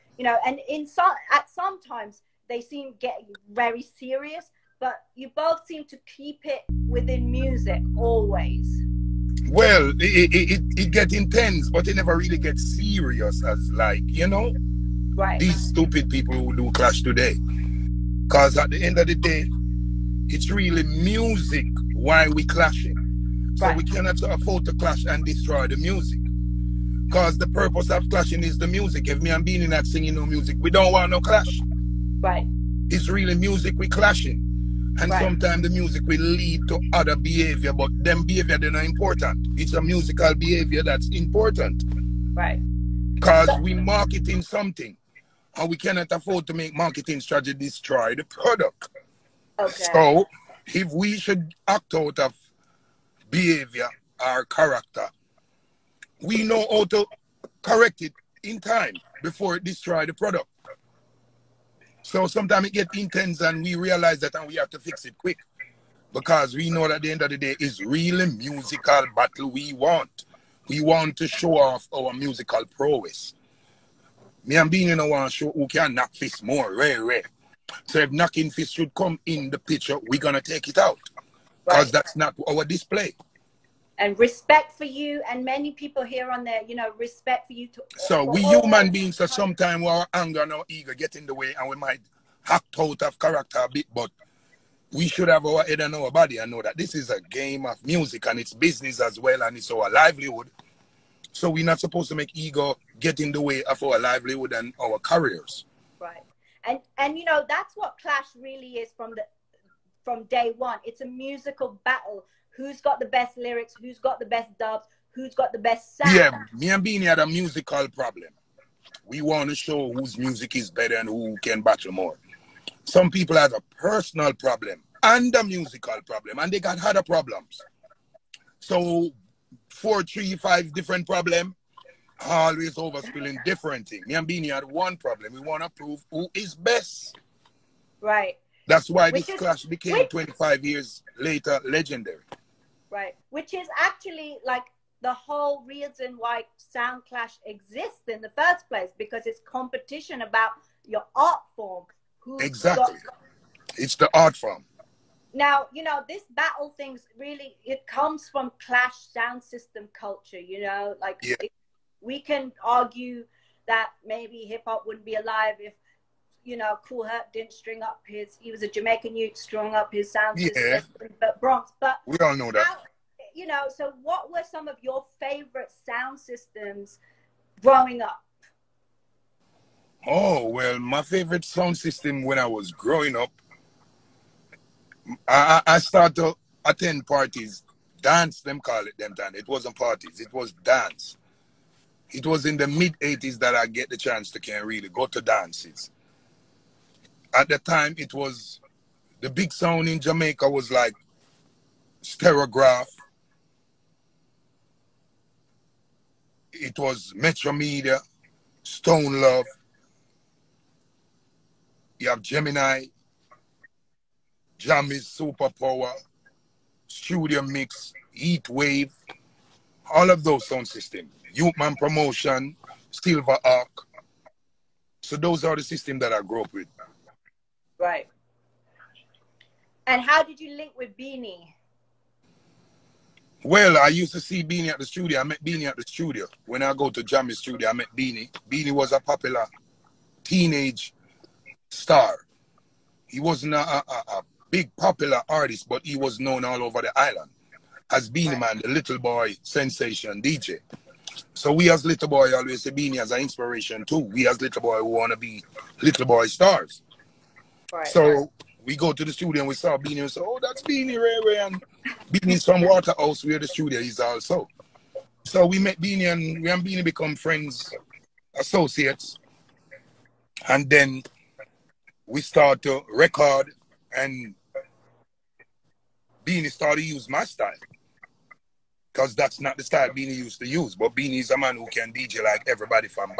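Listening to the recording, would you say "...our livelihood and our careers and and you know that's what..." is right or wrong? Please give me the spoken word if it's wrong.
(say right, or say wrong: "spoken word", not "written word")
right.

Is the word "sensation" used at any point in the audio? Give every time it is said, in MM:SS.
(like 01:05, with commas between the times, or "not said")
04:09.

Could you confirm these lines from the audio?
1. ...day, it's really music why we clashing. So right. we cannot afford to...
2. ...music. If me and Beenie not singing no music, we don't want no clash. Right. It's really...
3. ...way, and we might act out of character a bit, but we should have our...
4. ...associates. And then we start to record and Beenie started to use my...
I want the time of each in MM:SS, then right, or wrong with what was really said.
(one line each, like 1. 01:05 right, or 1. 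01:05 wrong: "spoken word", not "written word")
1. 00:19 right
2. 00:28 right
3. 01:31 right
4. 04:28 right.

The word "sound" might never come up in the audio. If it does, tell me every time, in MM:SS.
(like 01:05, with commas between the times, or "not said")
01:55, 02:26, 02:39, 02:50, 02:55, 03:01, 03:19, 03:40.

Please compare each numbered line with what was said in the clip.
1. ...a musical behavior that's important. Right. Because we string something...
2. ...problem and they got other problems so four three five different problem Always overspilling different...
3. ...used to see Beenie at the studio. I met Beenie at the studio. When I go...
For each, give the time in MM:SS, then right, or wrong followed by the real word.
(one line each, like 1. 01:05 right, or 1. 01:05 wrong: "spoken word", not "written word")
1. 00:39 wrong: "marketing", not "string"
2. 02:06 right
3. 03:53 right.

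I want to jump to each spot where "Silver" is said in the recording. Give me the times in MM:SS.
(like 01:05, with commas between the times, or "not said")
03:42.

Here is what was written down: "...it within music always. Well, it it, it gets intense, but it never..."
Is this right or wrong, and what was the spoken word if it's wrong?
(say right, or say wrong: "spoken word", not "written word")
right.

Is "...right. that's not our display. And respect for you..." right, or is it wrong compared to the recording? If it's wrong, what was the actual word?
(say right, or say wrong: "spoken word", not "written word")
right.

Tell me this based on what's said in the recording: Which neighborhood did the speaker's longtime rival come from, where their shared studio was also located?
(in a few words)
Waterhouse.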